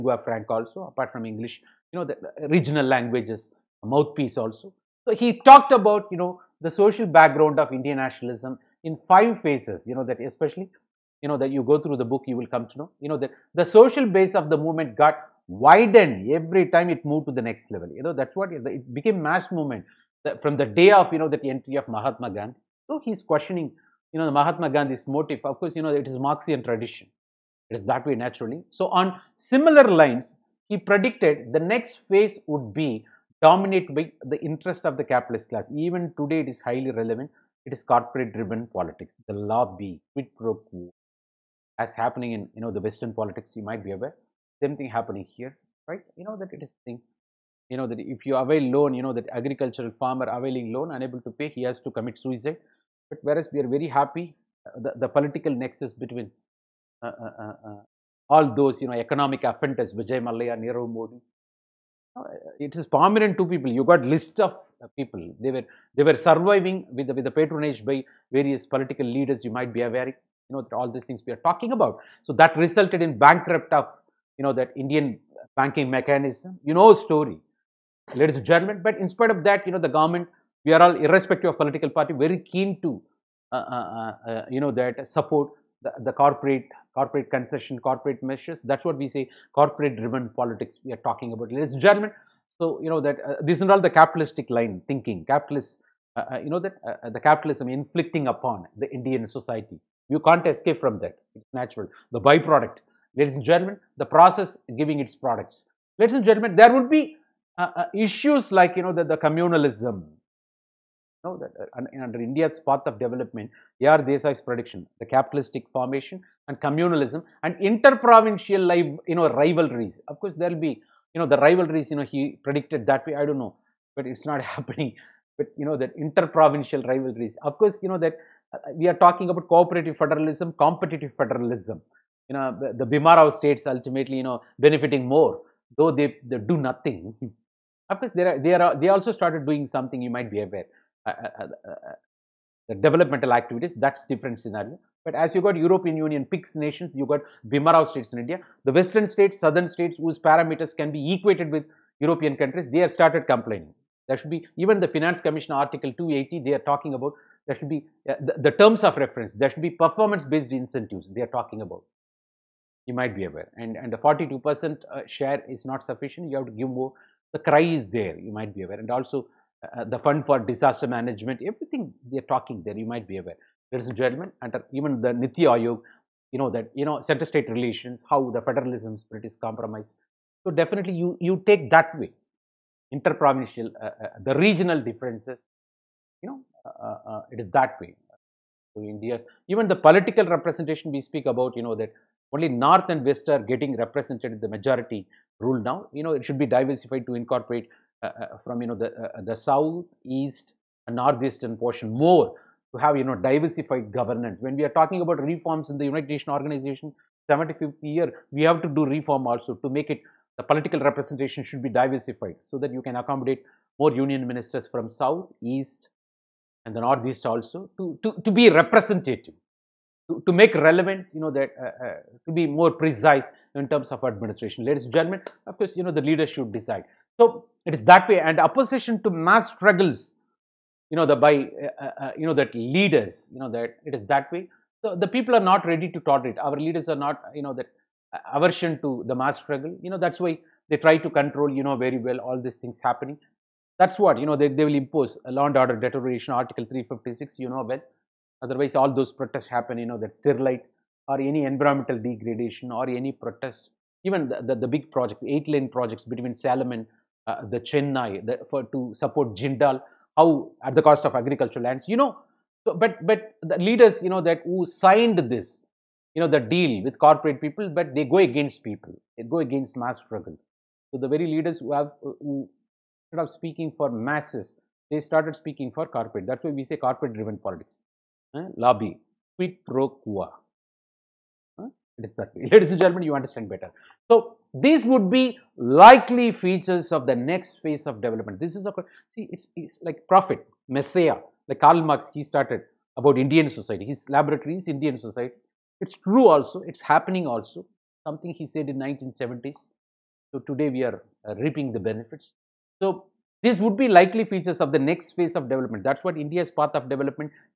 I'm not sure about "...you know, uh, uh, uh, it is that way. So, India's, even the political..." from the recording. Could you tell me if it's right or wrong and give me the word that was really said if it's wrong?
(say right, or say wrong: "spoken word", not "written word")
right.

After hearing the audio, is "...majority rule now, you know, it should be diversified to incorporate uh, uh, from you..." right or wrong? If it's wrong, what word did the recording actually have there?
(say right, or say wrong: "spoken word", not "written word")
right.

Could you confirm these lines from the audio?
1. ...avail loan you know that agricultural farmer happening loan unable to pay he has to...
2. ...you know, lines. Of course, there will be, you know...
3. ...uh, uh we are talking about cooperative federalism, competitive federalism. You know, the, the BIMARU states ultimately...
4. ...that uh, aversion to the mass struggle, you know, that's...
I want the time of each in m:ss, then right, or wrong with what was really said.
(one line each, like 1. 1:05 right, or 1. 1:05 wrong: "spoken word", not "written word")
1. 0:48 wrong: "availing", not "happening"
2. 1:59 wrong: "rivalries", not "lines"
3. 2:08 right
4. 3:57 right.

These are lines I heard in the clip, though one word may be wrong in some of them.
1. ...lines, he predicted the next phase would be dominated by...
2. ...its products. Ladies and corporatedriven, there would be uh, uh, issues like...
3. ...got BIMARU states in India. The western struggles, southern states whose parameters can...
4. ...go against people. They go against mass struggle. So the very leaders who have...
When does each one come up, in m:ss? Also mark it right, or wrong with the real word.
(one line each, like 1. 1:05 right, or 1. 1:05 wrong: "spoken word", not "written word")
1. 0:29 right
2. 1:44 wrong: "gentlemen", not "corporatedriven"
3. 2:27 wrong: "states", not "struggles"
4. 4:28 right.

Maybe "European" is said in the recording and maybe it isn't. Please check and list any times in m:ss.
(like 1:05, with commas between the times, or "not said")
2:25, 2:31.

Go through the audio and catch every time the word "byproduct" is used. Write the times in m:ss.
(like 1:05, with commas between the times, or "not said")
1:42.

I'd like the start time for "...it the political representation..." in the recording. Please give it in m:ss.
3:29.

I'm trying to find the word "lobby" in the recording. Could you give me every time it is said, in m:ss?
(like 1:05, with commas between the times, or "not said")
0:39, 4:38.